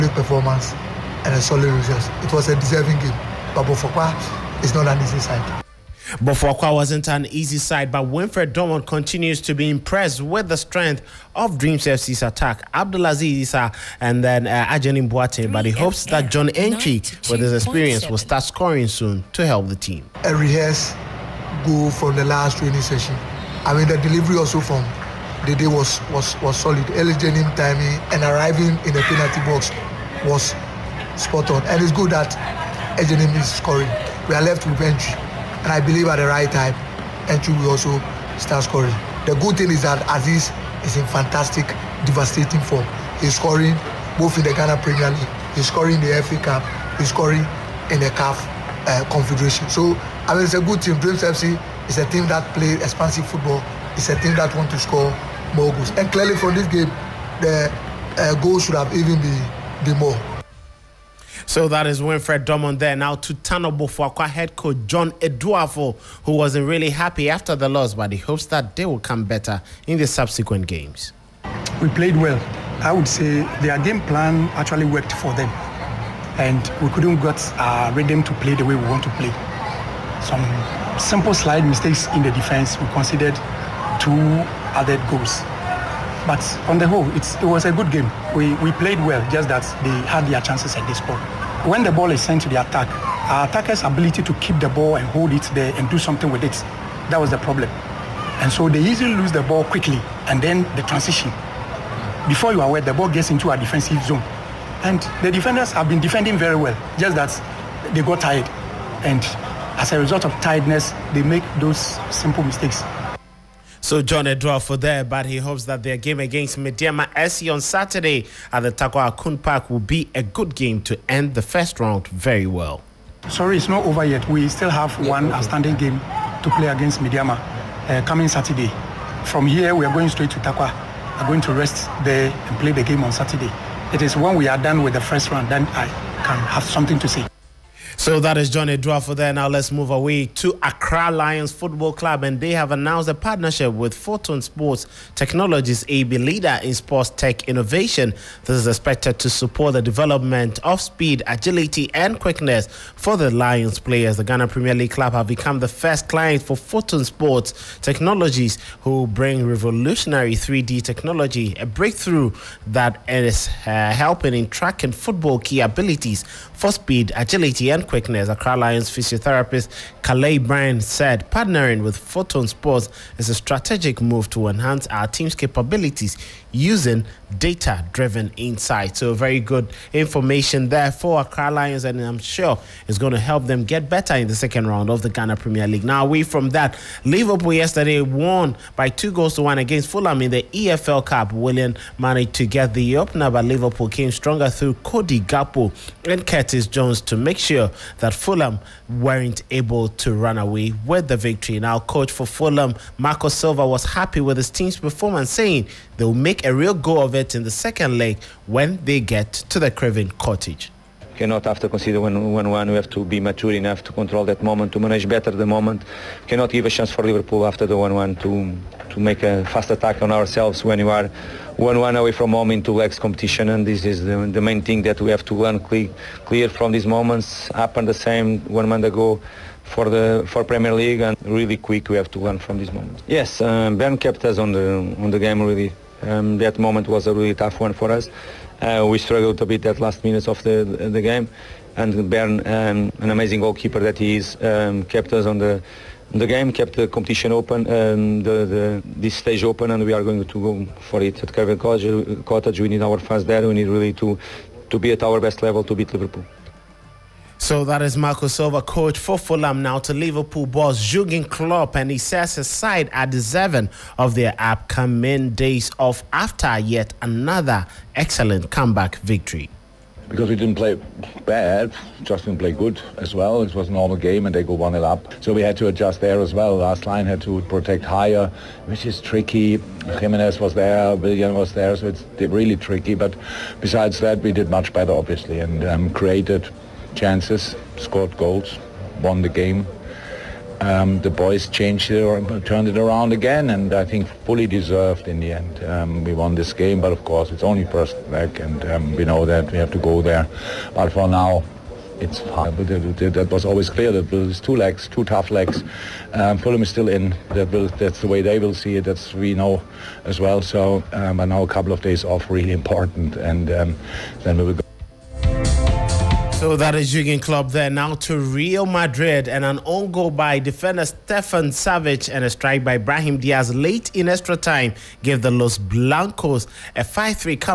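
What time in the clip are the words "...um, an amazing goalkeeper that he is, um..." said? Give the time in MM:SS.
04:02.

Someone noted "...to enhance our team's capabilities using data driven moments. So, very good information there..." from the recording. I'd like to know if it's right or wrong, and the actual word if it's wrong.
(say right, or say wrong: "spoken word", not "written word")
wrong: "insights", not "moments".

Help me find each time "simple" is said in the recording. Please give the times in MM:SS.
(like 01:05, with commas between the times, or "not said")
01:21, 01:52.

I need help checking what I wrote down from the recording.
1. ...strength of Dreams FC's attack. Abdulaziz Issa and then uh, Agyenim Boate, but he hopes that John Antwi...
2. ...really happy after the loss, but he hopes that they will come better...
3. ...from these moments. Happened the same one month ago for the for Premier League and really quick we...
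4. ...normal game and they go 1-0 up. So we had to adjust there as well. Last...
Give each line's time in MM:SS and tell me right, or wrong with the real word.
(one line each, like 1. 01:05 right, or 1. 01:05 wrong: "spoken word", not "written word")
1. 00:10 right
2. 01:06 right
3. 03:46 right
4. 04:33 right.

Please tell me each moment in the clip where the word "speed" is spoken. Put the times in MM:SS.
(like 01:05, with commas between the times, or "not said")
02:30, 02:46.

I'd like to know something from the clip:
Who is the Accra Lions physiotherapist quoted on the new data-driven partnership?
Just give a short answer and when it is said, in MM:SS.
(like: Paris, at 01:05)
Kalei Bryan, at 02:50.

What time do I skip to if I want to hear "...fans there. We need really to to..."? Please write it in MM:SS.
04:12.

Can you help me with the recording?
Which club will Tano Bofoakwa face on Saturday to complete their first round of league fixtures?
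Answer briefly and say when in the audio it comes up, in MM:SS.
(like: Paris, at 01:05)
Medeama SC, at 01:56.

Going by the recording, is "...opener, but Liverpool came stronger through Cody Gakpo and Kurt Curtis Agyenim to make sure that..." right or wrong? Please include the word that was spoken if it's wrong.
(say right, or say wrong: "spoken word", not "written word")
wrong: "Jones", not "Agyenim".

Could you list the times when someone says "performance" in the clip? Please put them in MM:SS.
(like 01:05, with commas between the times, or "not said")
00:00, 03:24.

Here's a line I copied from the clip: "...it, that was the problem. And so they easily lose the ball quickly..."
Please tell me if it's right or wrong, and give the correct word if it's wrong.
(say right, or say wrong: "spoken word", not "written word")
right.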